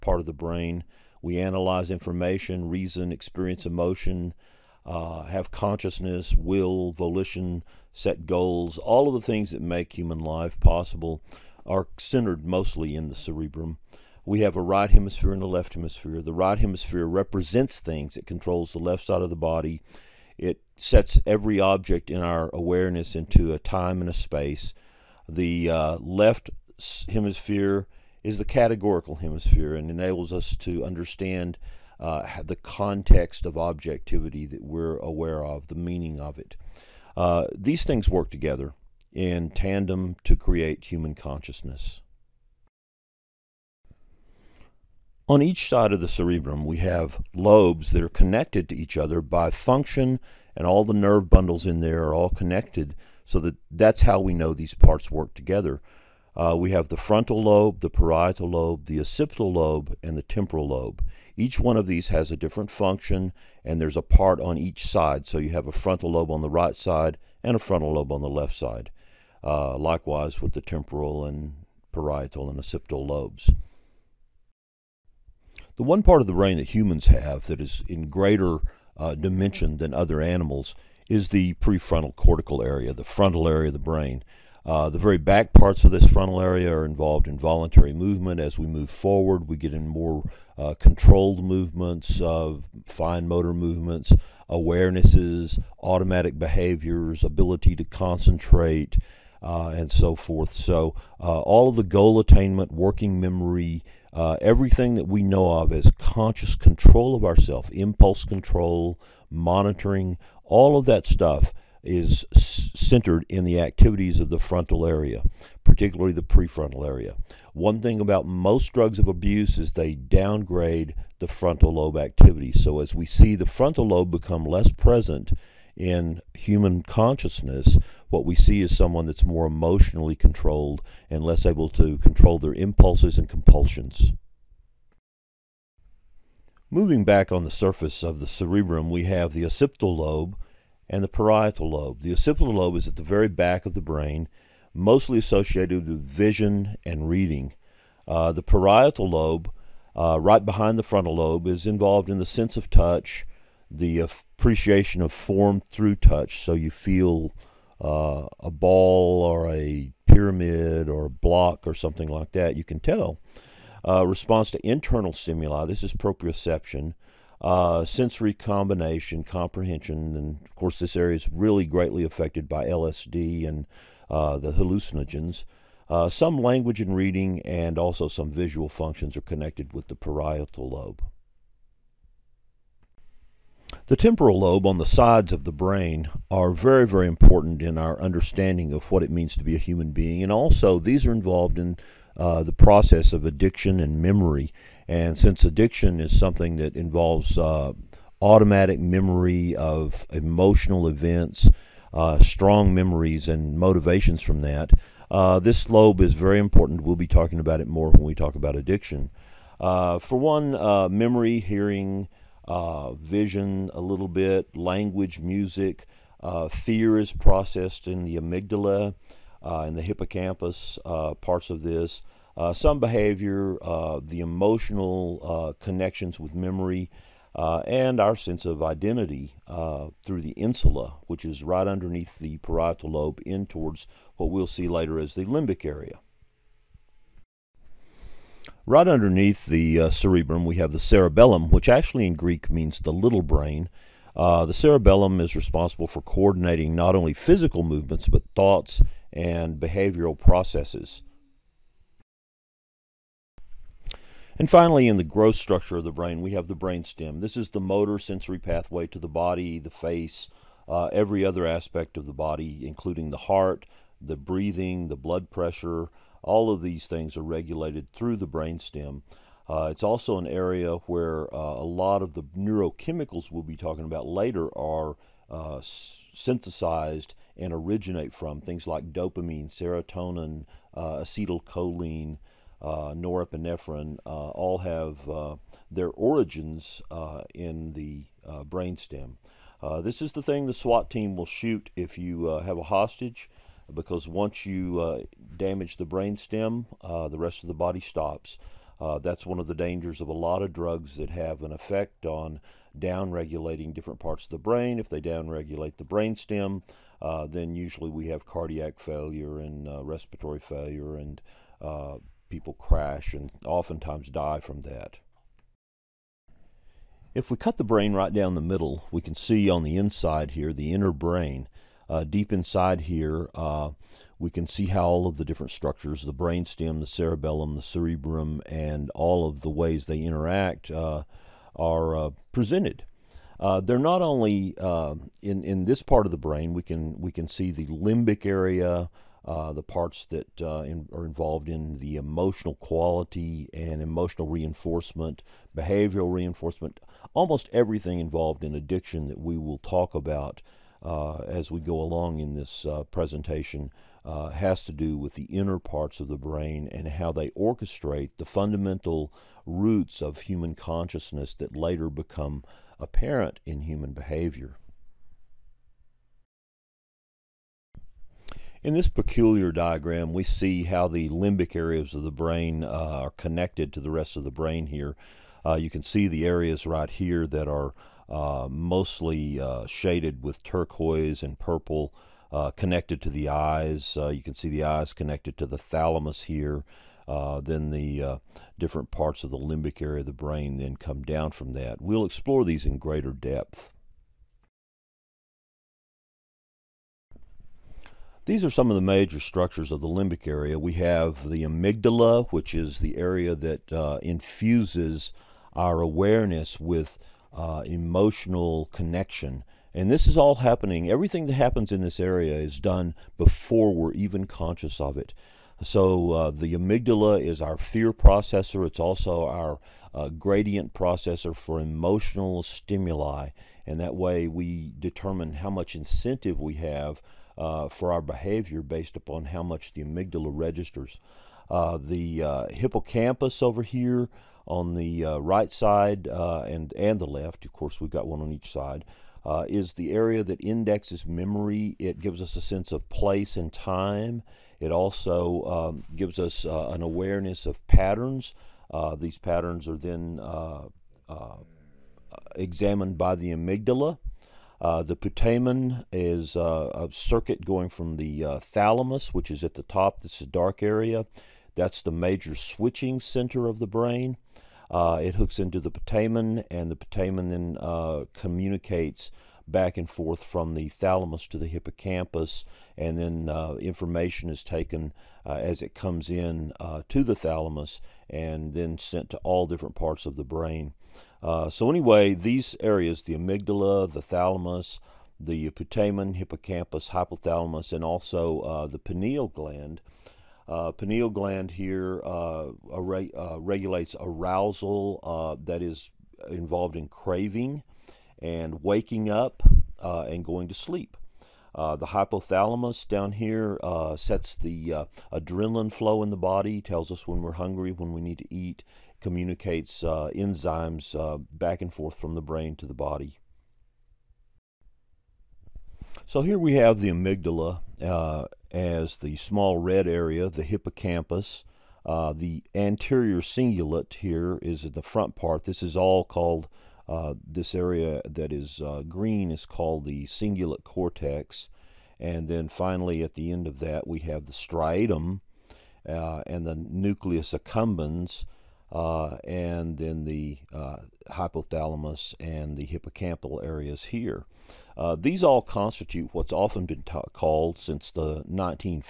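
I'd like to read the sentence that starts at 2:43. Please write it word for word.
Uh, response to internal stimuli, this is proprioception.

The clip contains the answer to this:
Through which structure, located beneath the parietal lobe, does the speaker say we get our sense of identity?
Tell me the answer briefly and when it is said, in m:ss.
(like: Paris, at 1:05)
Insula, at 3:50.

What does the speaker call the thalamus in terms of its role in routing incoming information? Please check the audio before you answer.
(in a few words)
Major switching center.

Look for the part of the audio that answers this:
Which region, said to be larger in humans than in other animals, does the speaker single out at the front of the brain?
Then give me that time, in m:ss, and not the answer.
1:21.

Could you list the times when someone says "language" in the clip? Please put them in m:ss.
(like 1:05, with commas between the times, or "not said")
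2:56, 3:34.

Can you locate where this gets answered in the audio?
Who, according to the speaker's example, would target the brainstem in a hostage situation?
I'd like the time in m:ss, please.
4:50.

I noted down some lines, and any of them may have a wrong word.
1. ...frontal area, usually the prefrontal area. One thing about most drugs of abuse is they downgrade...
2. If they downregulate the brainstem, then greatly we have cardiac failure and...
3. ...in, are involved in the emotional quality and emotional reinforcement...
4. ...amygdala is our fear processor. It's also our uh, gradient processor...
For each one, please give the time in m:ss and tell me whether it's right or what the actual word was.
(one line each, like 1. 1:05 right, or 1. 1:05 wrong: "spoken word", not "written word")
1. 1:54 wrong: "particularly", not "usually"
2. 5:04 wrong: "usually", not "greatly"
3. 5:40 right
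4. 6:56 right.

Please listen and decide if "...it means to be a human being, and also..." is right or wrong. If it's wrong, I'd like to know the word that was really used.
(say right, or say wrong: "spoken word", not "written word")
right.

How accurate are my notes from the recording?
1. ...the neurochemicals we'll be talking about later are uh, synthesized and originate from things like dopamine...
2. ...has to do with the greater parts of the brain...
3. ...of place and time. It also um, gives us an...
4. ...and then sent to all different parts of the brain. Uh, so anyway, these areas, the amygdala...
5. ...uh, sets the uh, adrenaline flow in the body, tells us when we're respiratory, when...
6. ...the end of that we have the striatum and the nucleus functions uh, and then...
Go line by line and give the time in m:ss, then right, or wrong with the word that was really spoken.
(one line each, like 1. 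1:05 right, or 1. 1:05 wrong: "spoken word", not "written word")
1. 4:32 right
2. 5:54 wrong: "inner", not "greater"
3. 7:22 right
4. 7:58 right
5. 8:23 wrong: "hungry", not "respiratory"
6. 8:53 wrong: "accumbens", not "functions".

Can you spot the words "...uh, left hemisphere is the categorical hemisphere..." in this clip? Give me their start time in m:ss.
0:25.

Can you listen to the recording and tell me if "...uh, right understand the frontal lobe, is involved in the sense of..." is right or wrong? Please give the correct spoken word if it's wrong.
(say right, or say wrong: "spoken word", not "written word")
wrong: "behind", not "understand".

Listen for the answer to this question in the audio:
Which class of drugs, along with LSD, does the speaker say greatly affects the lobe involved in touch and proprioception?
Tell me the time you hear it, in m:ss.
2:54.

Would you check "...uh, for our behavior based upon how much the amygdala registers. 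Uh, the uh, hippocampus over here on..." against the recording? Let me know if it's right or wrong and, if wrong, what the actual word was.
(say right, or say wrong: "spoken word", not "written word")
right.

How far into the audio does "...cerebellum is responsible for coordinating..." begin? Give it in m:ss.
4:04.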